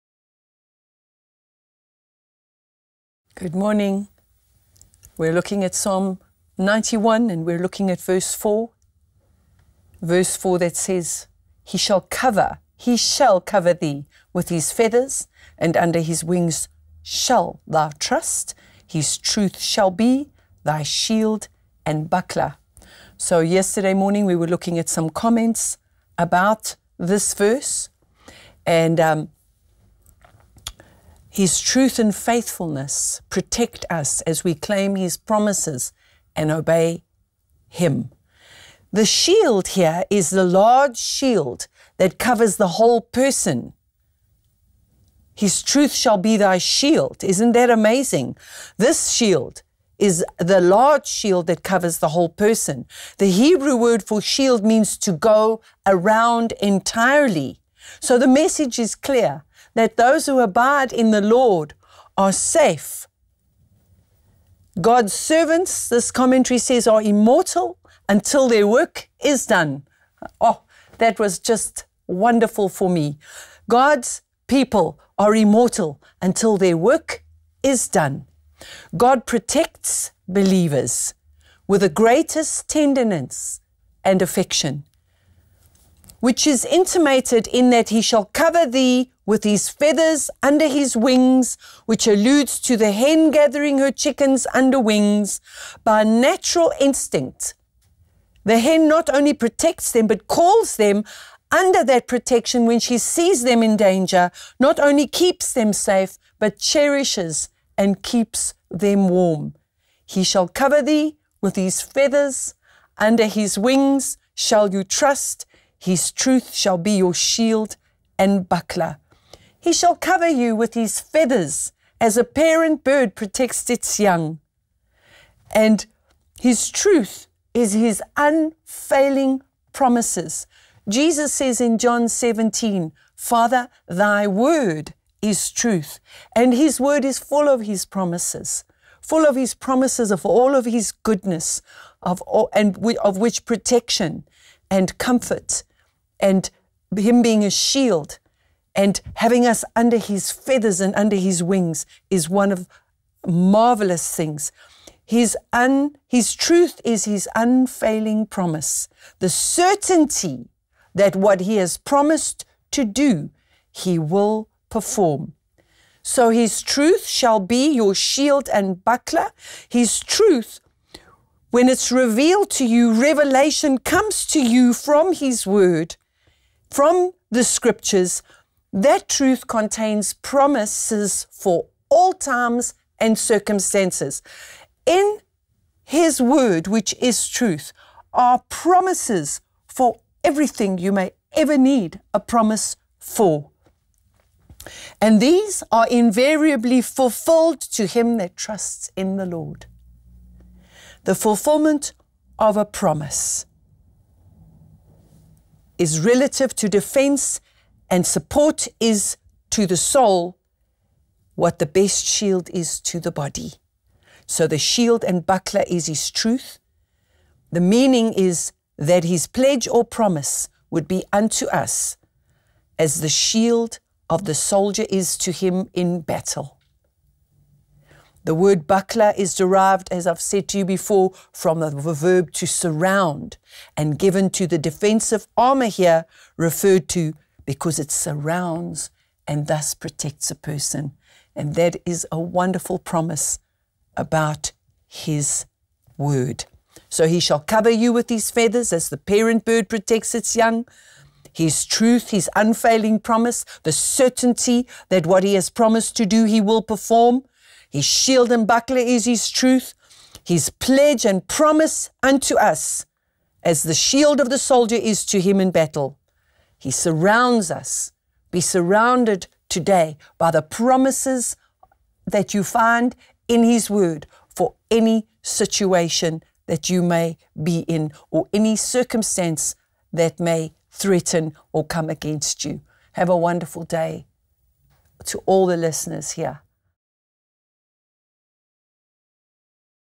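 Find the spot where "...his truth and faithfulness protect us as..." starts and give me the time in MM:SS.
00:31.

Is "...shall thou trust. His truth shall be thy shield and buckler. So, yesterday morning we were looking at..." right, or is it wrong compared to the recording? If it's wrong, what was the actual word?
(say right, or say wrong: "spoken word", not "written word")
right.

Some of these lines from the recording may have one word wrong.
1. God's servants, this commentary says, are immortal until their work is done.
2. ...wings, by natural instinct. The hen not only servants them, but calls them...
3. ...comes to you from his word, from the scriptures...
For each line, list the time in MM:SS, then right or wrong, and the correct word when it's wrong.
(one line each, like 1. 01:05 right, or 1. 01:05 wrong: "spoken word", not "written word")
1. 01:04 right
2. 01:34 wrong: "protects", not "servants"
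3. 02:53 right.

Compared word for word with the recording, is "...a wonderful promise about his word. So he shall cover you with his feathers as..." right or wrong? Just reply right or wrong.
right.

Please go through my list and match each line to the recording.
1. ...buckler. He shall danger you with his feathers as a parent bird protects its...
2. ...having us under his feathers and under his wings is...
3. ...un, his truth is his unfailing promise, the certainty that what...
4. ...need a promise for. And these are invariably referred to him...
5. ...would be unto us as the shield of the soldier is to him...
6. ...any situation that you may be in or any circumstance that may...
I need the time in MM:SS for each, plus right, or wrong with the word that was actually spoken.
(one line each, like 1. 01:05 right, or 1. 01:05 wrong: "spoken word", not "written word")
1. 01:58 wrong: "cover", not "danger"
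2. 02:29 right
3. 02:35 right
4. 03:11 wrong: "fulfilled", not "referred"
5. 03:40 right
6. 04:34 right.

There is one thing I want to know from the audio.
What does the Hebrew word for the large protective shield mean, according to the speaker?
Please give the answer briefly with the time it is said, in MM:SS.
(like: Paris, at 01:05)
To go around entirely, at 00:54.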